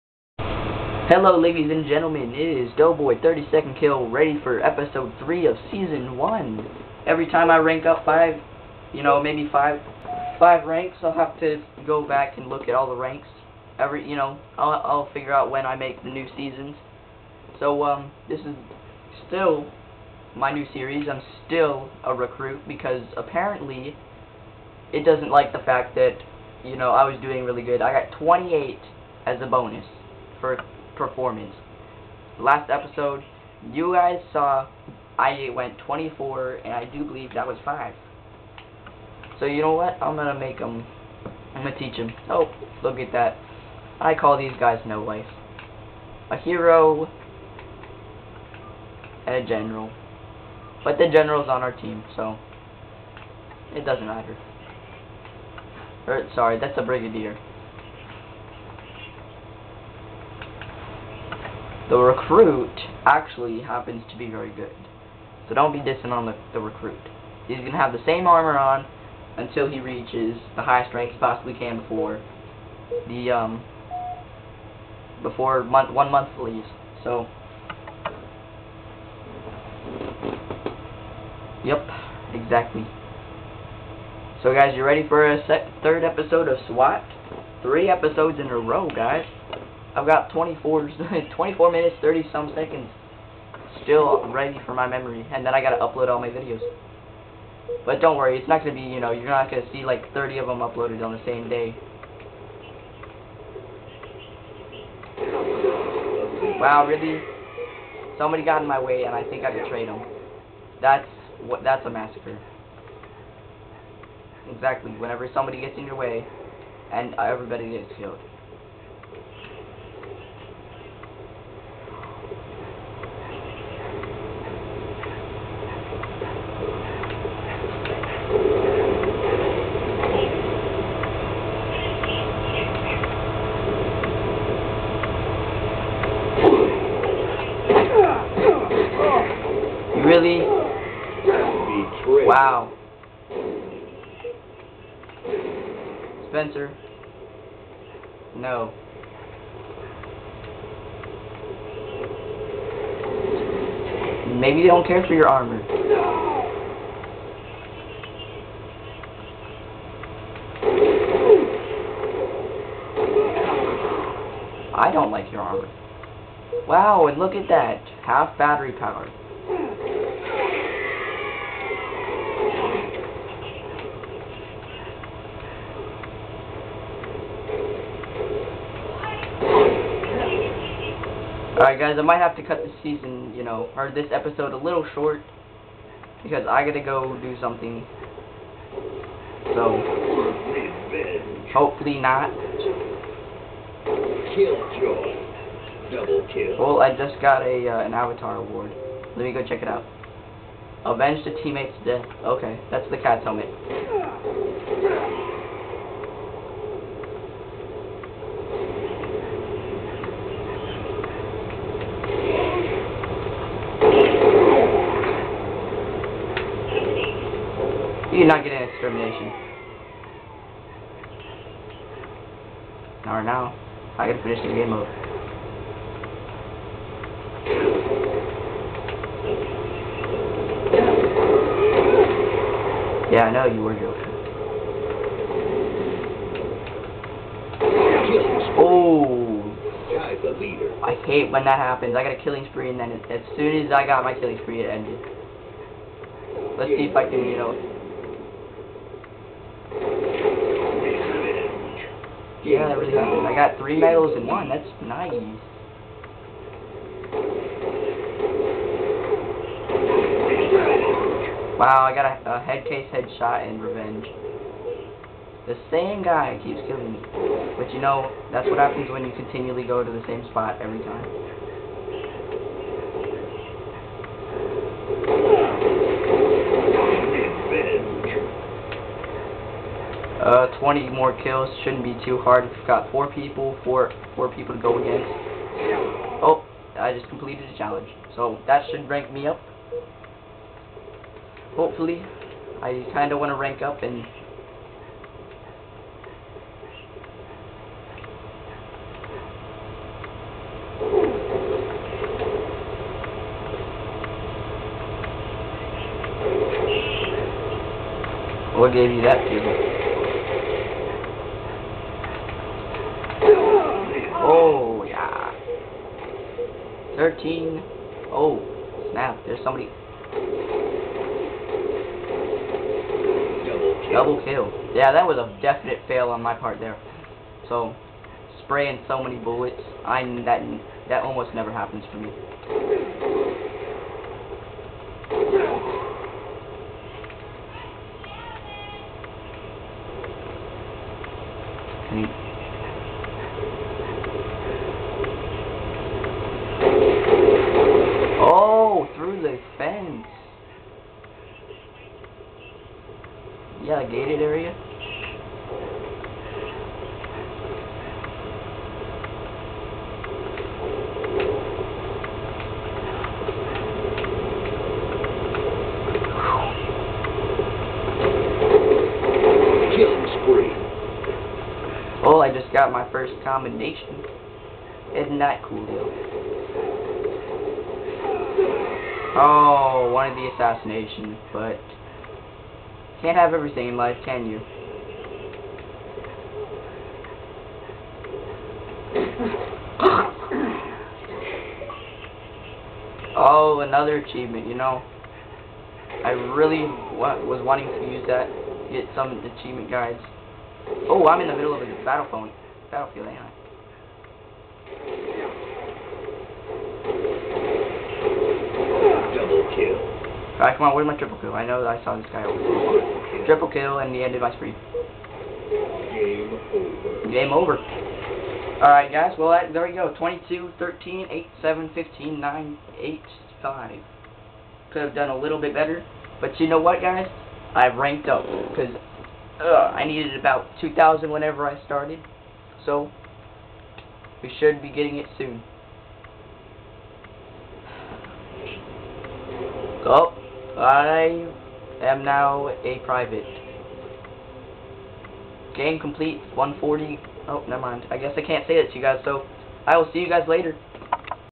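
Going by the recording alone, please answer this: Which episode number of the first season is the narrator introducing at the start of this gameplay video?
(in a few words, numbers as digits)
3.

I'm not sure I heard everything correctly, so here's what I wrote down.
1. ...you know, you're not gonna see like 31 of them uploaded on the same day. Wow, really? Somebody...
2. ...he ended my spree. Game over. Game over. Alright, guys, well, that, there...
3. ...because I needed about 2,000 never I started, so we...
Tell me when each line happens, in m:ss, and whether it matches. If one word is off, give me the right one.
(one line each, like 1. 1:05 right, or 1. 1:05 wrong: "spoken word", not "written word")
1. 1:38 wrong: "30", not "31"
2. 6:53 right
3. 7:08 wrong: "whenever", not "never".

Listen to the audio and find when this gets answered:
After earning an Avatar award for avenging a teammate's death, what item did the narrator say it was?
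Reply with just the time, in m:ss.
3:22.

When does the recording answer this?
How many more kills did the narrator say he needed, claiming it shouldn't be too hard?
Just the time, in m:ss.
4:40.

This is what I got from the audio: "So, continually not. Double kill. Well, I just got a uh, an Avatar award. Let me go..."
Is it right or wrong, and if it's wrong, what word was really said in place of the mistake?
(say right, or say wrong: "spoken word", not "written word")
wrong: "hopefully", not "continually".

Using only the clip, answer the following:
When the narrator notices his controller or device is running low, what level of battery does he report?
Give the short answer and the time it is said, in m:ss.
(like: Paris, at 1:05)
Half, at 2:48.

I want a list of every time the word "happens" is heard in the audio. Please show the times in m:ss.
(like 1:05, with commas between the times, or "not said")
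1:03, 4:01, 4:28, 5:31.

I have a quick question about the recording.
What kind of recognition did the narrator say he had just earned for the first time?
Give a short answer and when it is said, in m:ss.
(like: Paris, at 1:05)
Commendation, at 6:13.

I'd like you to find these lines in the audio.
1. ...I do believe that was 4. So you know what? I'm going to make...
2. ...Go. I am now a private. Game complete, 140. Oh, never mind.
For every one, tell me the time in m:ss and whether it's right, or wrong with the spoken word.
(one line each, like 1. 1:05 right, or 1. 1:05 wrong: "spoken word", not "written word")
1. 0:36 wrong: "5", not "4"
2. 7:19 right.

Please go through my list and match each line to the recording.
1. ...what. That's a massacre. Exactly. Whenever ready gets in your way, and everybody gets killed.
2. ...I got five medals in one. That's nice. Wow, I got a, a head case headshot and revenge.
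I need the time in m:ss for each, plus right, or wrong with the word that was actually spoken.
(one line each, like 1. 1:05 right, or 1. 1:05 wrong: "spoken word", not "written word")
1. 1:51 wrong: "somebody", not "ready"
2. 4:13 wrong: "three", not "five".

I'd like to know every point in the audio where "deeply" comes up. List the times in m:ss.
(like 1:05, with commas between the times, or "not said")
not said.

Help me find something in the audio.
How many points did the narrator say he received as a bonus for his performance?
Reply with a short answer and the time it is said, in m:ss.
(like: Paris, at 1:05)
28, at 0:28.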